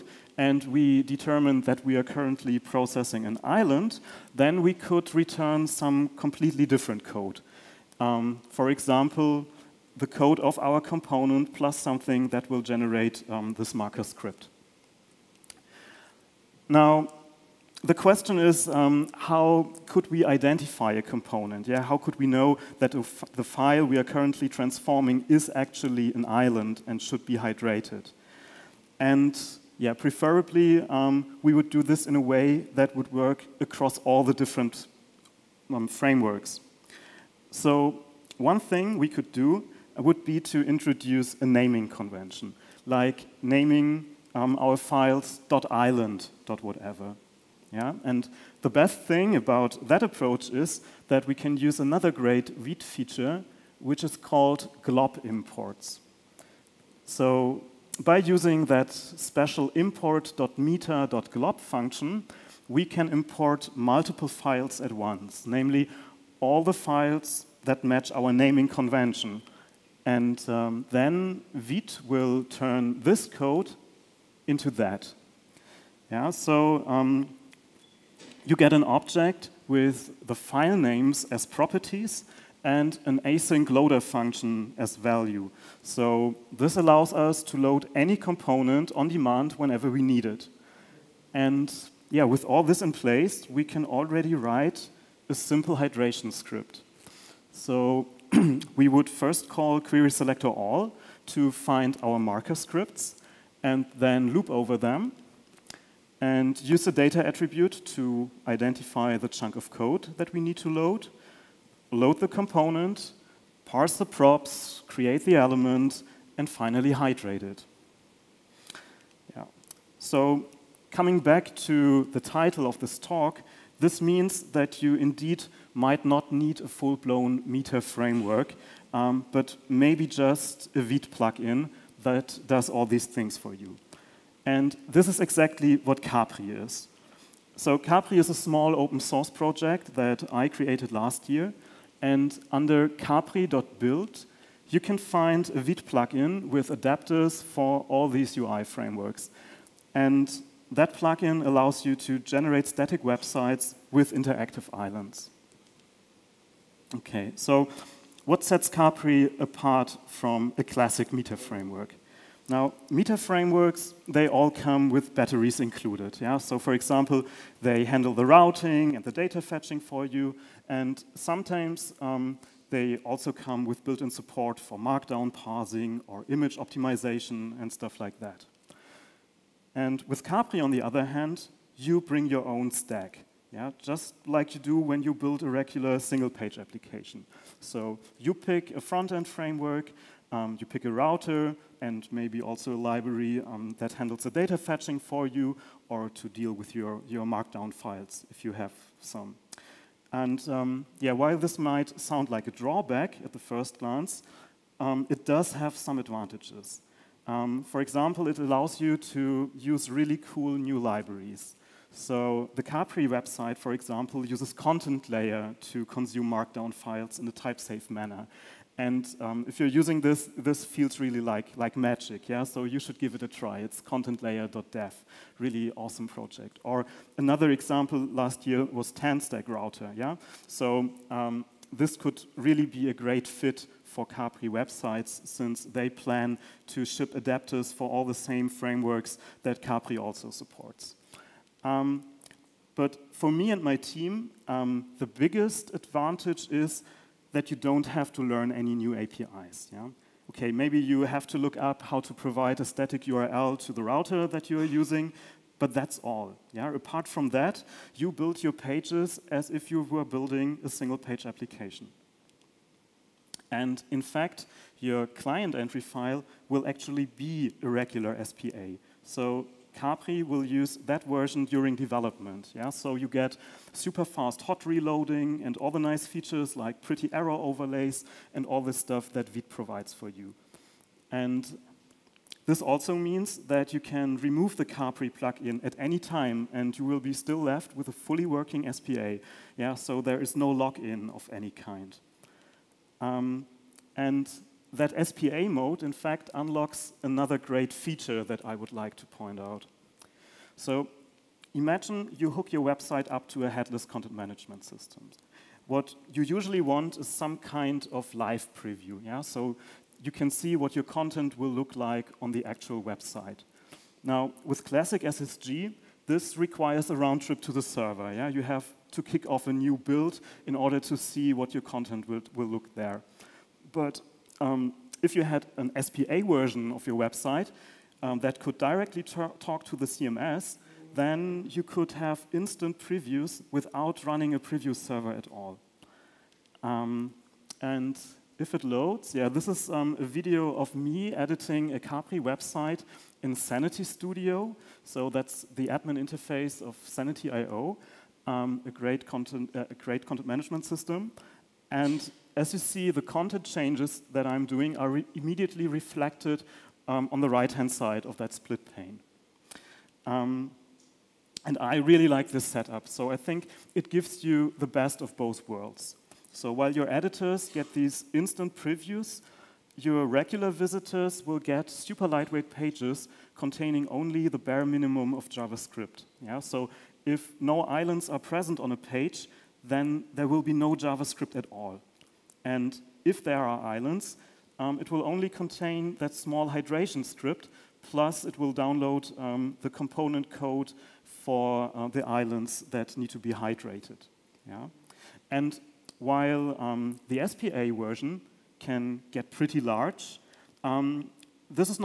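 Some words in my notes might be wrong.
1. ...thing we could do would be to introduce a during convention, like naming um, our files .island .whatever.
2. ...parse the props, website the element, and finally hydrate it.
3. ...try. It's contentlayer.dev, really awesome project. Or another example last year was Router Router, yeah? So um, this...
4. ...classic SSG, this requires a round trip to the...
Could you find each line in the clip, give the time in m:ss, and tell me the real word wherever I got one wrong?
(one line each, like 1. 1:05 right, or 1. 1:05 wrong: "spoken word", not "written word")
1. 0:38 wrong: "naming", not "during"
2. 1:53 wrong: "create", not "website"
3. 3:43 wrong: "TanStack", not "Router"
4. 5:14 right.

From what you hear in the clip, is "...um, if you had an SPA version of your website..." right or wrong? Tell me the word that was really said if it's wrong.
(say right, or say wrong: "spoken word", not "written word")
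right.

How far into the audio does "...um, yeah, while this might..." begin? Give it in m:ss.
3:20.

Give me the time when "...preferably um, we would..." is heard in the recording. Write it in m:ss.
0:29.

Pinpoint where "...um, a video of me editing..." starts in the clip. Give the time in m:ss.
5:39.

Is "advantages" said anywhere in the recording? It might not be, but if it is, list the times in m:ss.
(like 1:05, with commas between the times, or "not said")
3:25, 4:05.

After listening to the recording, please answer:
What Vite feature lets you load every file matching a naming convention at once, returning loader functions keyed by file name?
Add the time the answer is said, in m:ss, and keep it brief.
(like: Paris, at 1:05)
glob imports, at 0:54.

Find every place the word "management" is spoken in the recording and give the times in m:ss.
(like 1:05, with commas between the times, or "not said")
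5:04, 5:50.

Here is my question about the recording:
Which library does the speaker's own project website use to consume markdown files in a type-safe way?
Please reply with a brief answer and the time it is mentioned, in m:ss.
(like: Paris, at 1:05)
Contentlayer, at 3:34.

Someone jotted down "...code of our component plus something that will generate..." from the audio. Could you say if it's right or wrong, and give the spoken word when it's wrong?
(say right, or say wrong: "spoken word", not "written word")
right.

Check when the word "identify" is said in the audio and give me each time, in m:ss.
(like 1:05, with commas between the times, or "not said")
0:20, 1:48.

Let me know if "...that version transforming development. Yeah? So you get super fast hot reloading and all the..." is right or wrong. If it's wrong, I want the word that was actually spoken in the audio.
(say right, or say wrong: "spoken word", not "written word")
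wrong: "during", not "transforming".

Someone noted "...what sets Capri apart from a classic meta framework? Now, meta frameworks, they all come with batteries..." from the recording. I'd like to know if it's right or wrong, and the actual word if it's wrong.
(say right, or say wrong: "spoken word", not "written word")
right.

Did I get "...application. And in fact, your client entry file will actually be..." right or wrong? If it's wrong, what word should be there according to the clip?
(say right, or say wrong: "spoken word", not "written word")
right.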